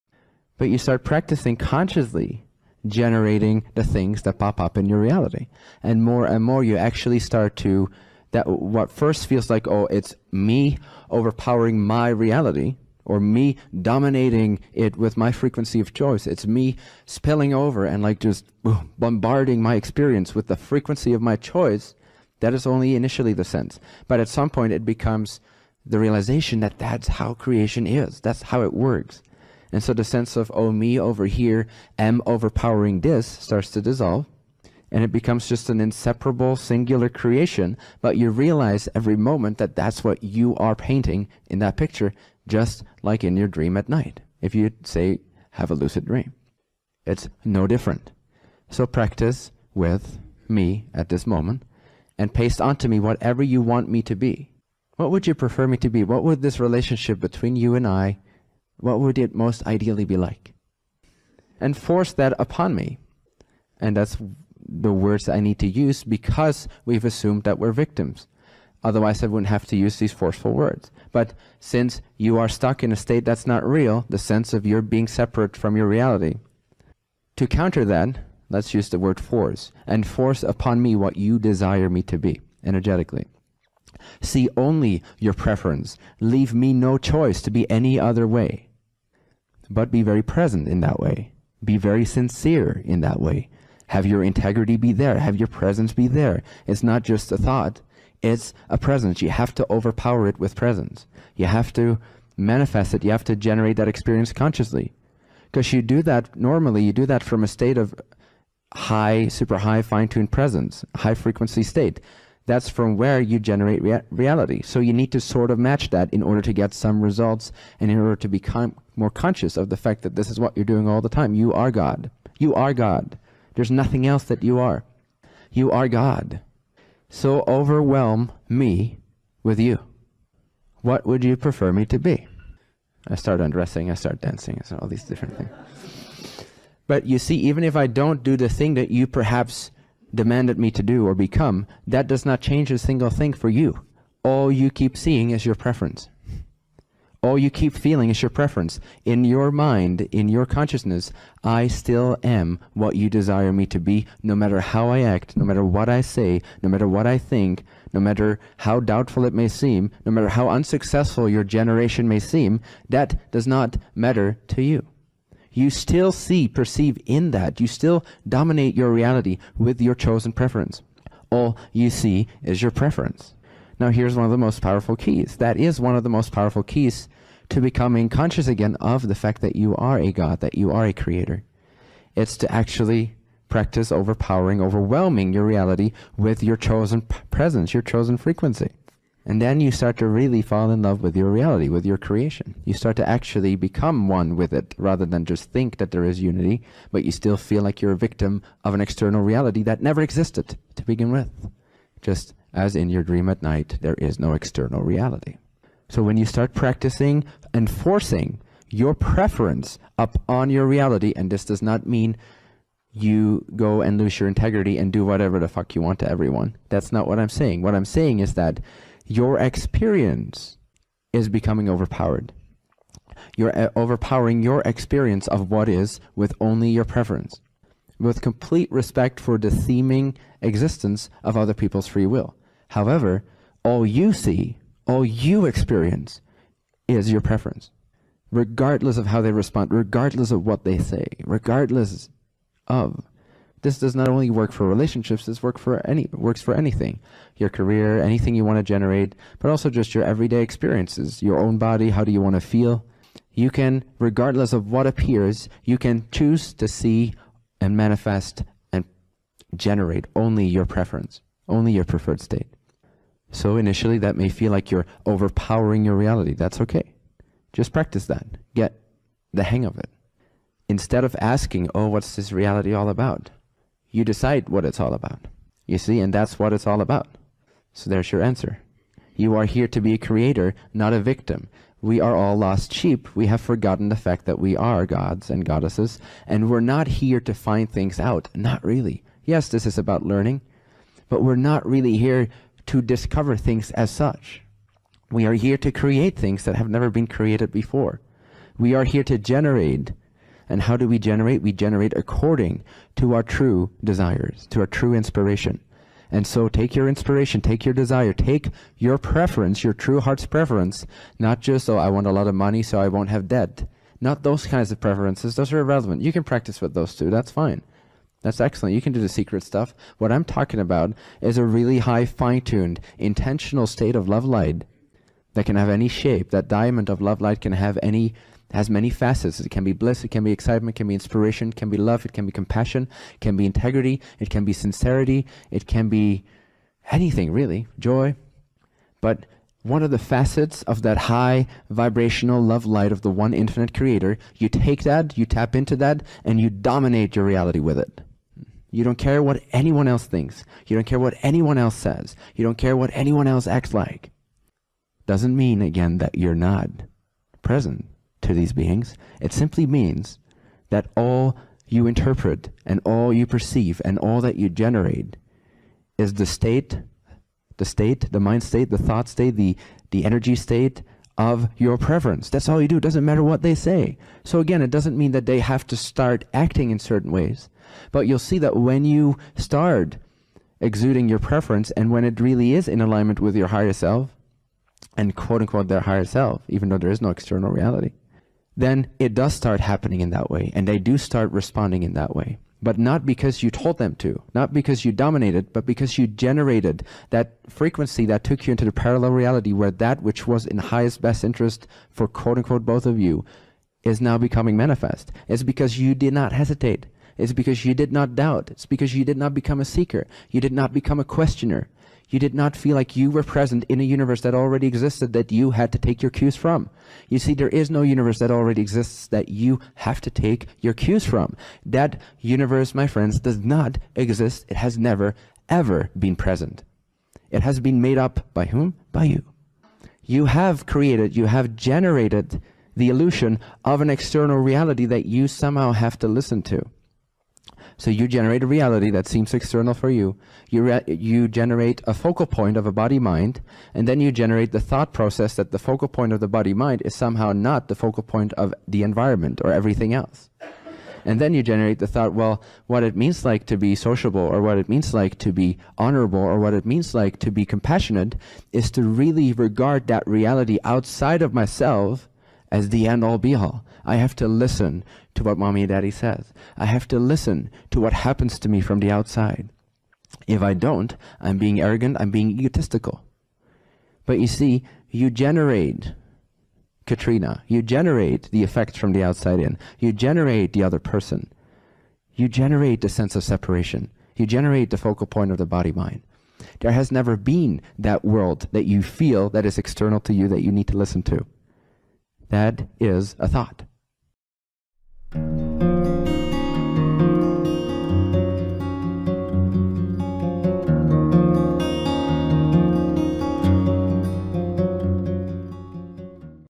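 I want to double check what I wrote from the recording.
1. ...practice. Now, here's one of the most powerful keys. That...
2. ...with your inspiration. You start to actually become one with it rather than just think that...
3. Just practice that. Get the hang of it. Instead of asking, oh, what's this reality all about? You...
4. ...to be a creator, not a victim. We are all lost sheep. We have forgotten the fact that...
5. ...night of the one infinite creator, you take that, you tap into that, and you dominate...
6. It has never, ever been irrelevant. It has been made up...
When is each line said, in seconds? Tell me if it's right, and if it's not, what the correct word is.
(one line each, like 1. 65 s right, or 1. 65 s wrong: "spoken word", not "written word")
1. 172 s wrong: "preference", not "practice"
2. 191 s wrong: "creation", not "inspiration"
3. 267 s right
4. 279 s right
5. 342 s wrong: "light", not "night"
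6. 424 s wrong: "present", not "irrelevant".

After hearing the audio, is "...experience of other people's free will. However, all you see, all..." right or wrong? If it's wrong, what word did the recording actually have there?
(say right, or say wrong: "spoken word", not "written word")
wrong: "existence", not "experience".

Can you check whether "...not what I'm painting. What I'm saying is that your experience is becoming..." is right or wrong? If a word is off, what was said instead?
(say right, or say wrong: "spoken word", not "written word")
wrong: "saying", not "painting".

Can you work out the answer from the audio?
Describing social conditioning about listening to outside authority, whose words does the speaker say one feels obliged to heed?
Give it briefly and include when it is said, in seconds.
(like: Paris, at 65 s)
mommy and daddy, at 465 s.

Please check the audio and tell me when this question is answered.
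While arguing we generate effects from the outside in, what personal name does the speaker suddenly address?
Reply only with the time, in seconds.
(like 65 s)
476 s.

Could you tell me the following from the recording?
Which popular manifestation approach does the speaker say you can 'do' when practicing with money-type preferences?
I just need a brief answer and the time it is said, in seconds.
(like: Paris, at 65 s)
the secret, at 319 s.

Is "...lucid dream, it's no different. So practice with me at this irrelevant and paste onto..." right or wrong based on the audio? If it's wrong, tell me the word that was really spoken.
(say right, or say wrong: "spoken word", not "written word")
wrong: "moment", not "irrelevant".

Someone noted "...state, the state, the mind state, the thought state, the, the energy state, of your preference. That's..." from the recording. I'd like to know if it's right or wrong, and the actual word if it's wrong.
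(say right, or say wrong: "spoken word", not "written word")
right.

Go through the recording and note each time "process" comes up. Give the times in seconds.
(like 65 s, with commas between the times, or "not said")
444 s.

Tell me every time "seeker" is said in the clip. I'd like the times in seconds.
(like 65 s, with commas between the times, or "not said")
409 s.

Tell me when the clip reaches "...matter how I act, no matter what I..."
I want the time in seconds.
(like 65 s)
154 s.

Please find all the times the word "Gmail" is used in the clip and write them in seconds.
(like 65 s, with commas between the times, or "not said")
not said.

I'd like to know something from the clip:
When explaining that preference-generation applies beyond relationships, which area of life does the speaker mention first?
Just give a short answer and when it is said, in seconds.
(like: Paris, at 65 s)
career, at 247 s.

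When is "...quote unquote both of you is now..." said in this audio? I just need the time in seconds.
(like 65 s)
402 s.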